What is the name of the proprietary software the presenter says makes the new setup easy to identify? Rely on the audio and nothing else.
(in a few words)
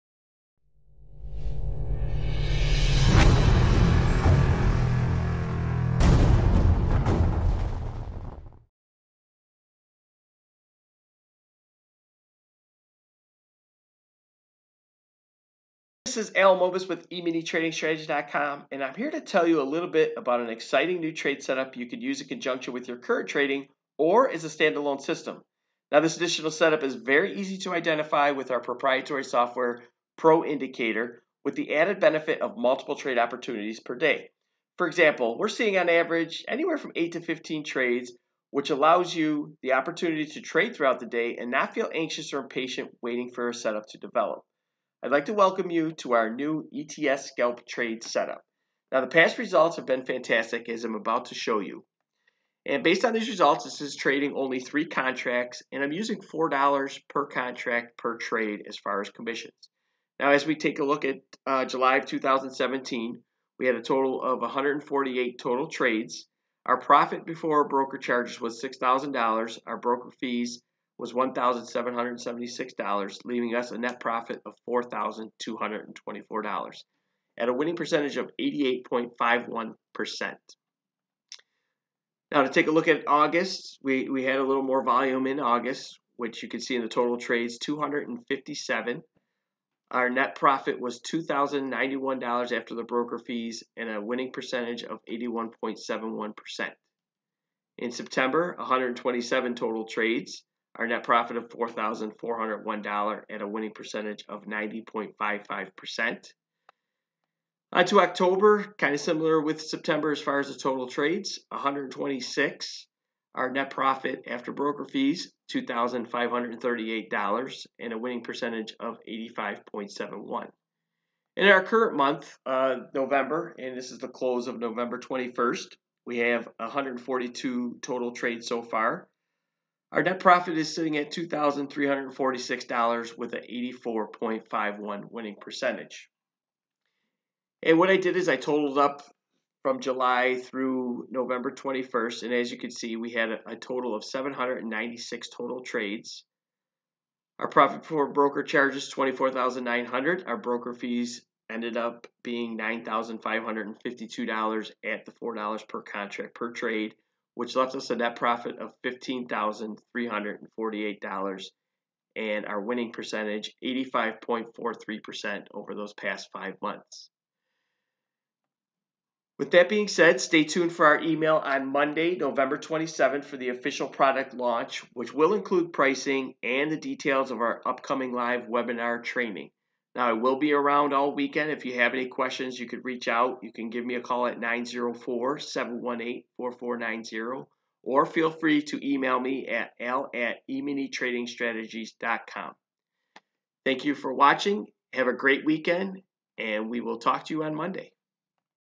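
Pro Indicator.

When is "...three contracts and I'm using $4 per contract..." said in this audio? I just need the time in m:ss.
0:54.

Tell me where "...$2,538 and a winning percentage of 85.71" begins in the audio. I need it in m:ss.
1:55.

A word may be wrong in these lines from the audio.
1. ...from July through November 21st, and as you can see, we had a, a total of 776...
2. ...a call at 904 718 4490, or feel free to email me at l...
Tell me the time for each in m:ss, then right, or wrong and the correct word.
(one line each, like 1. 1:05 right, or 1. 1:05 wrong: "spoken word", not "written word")
1. 2:19 wrong: "796", not "776"
2. 3:03 right.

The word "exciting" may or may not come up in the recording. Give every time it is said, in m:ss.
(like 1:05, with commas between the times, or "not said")
0:20.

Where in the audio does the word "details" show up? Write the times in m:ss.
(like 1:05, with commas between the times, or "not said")
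2:56.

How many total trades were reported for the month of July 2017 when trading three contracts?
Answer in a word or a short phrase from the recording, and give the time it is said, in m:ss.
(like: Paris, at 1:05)
148, at 1:04.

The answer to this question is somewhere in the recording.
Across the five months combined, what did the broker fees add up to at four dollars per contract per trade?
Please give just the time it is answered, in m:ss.
2:32.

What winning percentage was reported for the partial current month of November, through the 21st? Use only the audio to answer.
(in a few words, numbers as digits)
84.51%.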